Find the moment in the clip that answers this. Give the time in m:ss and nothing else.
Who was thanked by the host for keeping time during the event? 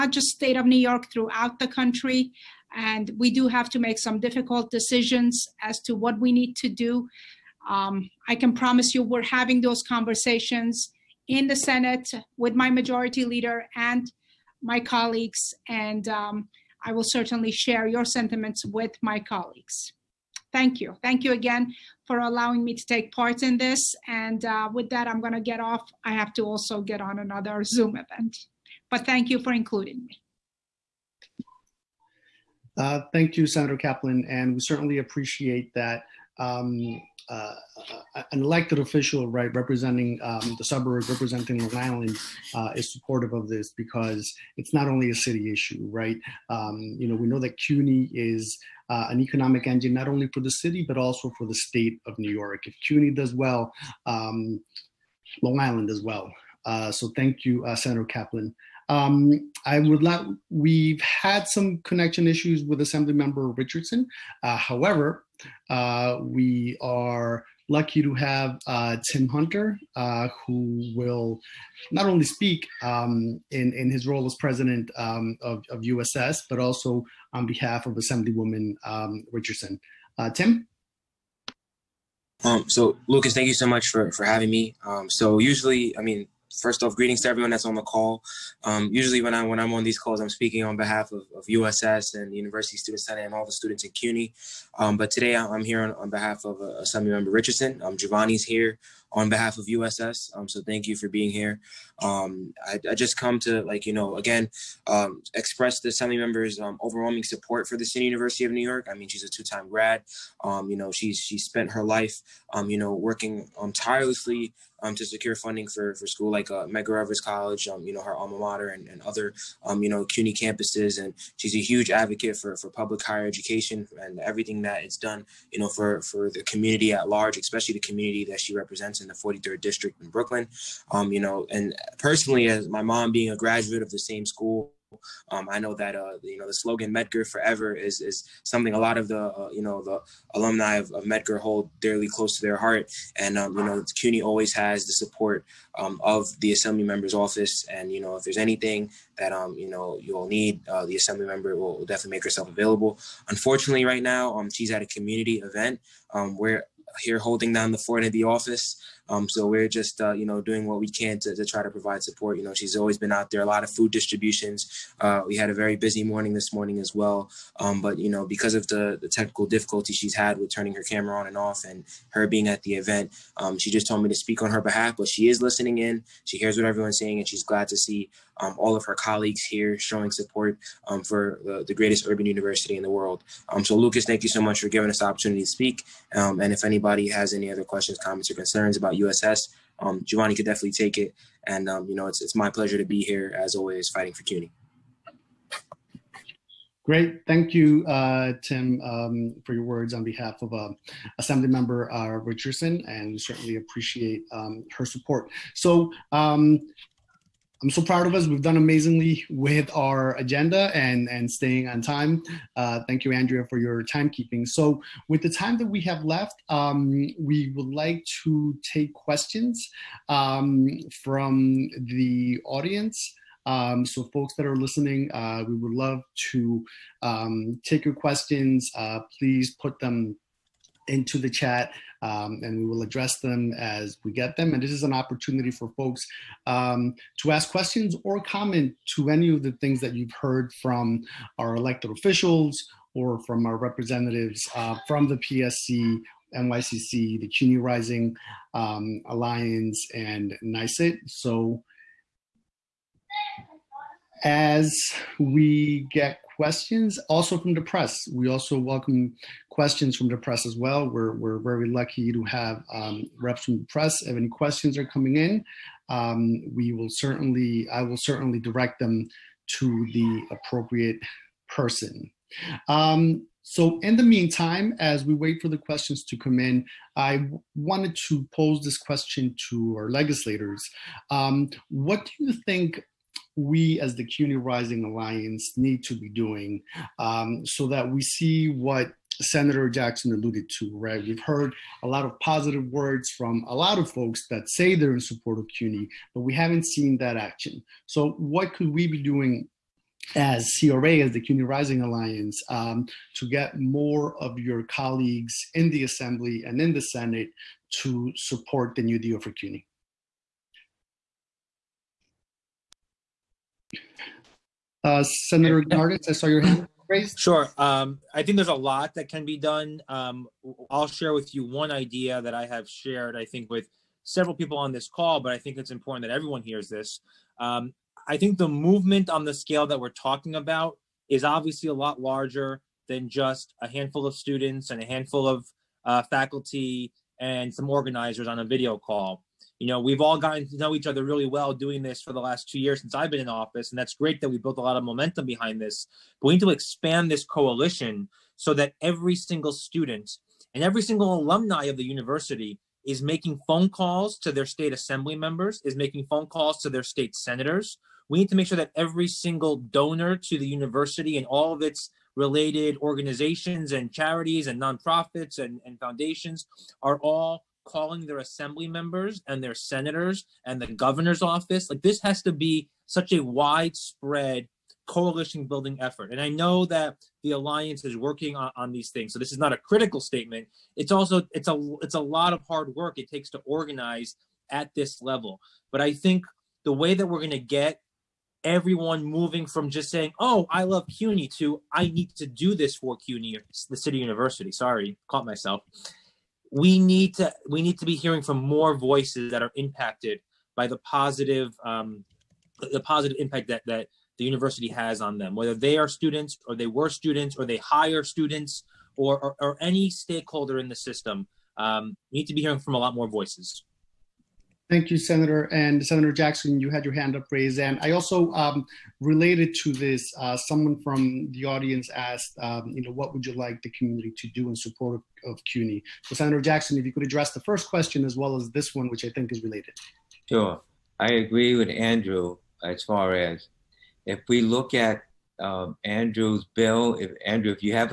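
3:33.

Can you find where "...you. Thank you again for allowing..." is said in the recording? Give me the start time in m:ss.
0:20.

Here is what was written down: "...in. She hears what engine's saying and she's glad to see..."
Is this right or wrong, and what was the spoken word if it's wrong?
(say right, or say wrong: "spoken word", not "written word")
wrong: "everyone", not "engine".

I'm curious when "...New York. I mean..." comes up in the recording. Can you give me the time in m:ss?
1:48.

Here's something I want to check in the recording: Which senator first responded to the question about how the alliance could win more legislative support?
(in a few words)
Senator Gounardes.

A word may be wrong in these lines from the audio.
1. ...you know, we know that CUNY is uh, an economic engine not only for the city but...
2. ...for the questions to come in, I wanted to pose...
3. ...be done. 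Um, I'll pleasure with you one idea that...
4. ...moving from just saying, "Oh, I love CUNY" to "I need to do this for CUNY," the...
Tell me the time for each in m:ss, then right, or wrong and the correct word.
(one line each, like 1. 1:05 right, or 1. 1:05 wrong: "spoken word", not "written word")
1. 0:46 right
2. 4:35 right
3. 5:19 wrong: "share", not "pleasure"
4. 6:29 right.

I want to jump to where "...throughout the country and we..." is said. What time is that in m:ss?
0:01.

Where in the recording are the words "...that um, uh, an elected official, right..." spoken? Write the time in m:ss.
0:35.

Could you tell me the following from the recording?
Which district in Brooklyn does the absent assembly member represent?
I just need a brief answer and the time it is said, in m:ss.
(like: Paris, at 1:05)
43rd District, at 2:09.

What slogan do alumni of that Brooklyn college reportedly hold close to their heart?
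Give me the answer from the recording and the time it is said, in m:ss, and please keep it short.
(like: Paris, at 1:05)
Medgar Forever, at 2:16.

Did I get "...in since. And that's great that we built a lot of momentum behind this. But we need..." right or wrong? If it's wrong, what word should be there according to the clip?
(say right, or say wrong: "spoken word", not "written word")
wrong: "office", not "since".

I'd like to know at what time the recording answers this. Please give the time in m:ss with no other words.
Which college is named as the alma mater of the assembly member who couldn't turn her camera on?
1:56.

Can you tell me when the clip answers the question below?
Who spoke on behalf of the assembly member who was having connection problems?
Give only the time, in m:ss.
1:09.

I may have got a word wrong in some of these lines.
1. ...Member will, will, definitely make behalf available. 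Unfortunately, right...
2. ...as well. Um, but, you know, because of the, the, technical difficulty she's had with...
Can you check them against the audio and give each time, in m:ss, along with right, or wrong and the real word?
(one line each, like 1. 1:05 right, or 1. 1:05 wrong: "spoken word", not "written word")
1. 2:31 wrong: "herself", not "behalf"
2. 2:46 right.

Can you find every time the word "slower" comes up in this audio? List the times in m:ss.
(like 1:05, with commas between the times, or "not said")
not said.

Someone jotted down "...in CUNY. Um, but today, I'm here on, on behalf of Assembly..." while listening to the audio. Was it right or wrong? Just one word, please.
right.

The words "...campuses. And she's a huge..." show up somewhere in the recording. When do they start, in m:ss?
2:00.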